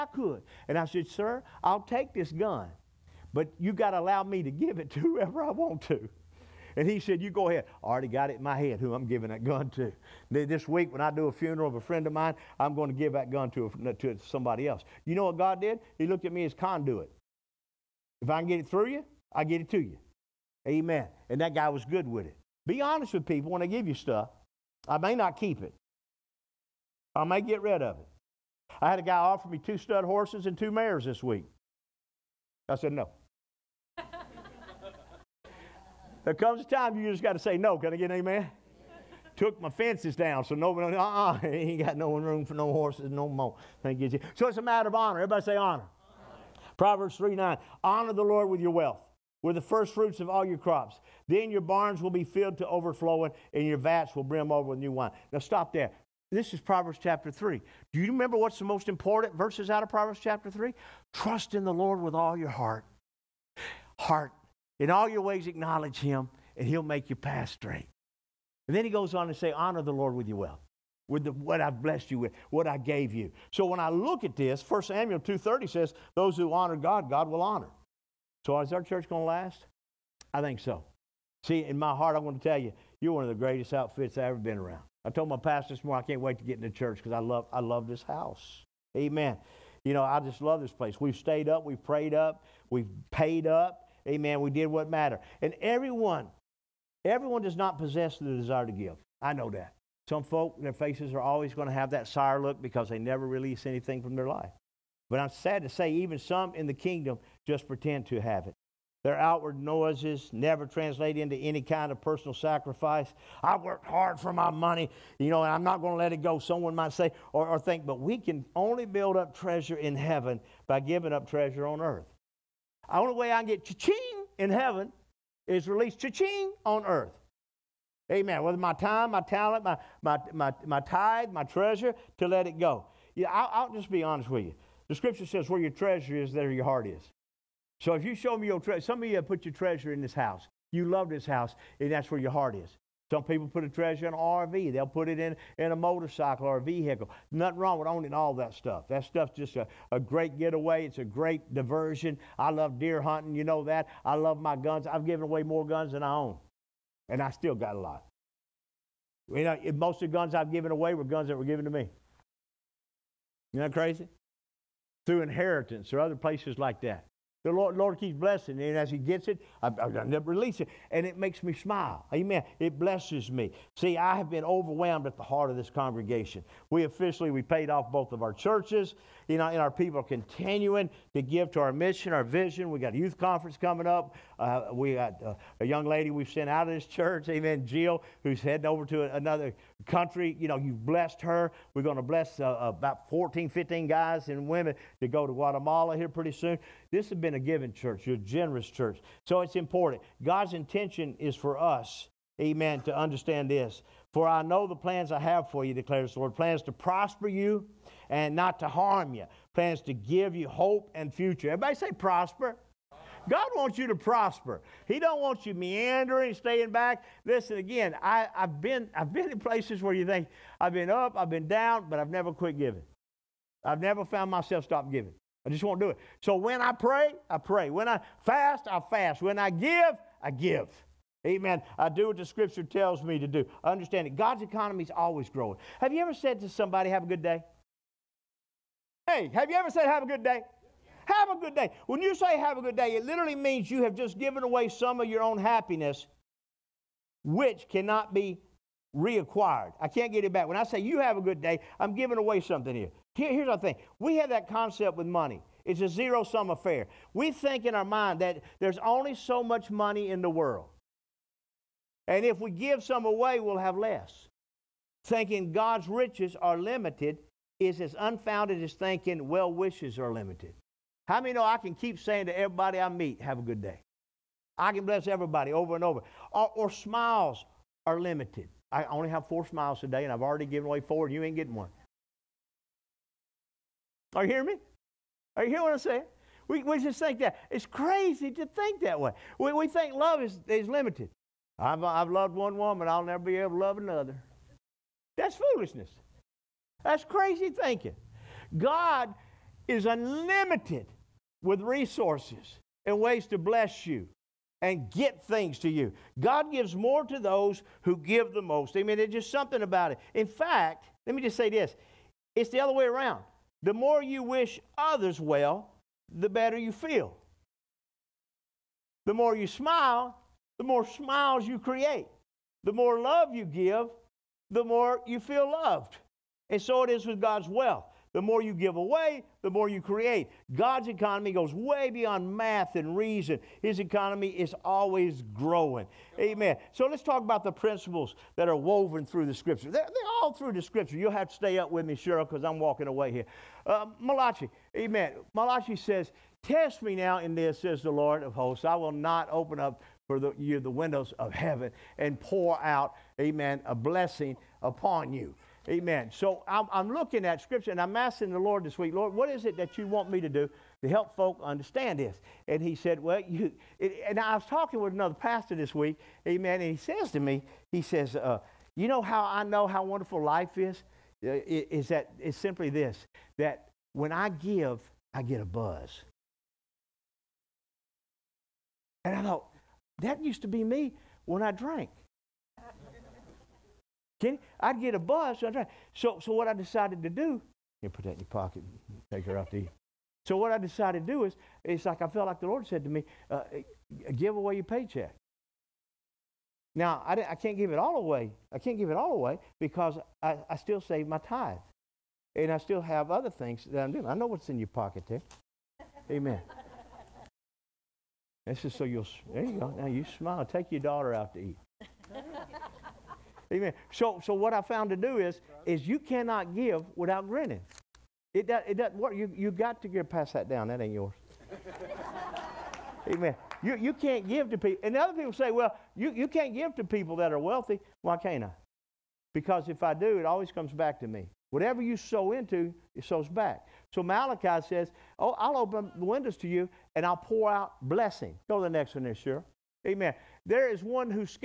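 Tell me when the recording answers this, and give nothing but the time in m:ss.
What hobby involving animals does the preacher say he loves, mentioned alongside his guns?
2:32.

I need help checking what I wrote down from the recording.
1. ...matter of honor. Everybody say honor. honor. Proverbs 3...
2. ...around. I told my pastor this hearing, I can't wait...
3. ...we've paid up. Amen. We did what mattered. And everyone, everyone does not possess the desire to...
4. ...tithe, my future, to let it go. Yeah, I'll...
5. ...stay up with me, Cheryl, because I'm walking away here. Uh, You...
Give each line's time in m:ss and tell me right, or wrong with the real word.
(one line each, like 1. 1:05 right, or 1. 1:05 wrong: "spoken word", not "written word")
1. 0:44 right
2. 1:24 wrong: "morning", not "hearing"
3. 1:32 right
4. 2:10 wrong: "treasure", not "future"
5. 5:41 wrong: "Malachi", not "You".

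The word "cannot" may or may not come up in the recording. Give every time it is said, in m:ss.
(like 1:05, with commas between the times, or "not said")
4:07, 6:55.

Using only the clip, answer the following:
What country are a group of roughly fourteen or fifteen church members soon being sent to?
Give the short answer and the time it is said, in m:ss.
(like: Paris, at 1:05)
Guatemala, at 3:15.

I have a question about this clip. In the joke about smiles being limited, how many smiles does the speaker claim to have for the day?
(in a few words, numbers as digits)
4.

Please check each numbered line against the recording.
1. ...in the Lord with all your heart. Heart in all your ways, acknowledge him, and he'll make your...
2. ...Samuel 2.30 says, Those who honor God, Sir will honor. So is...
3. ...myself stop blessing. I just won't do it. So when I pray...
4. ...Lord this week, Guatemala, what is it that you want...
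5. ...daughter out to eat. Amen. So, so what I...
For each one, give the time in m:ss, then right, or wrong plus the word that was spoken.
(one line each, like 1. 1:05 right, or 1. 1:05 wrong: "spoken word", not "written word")
1. 1:01 right
2. 1:14 wrong: "God", not "Sir"
3. 3:44 wrong: "giving", not "blessing"
4. 5:58 wrong: "Lord", not "Guatemala"
5. 6:50 right.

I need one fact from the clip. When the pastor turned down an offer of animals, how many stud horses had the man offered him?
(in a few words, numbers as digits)
2.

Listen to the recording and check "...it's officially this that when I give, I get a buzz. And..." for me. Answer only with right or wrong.
wrong.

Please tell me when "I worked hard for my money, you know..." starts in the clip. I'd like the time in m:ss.
1:53.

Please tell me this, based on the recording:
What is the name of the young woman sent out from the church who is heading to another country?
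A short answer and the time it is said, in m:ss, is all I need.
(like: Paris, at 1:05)
Jill, at 3:07.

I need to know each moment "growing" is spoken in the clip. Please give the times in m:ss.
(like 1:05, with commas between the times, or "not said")
3:55, 5:35.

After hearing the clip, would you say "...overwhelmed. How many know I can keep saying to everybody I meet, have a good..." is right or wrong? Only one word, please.
wrong.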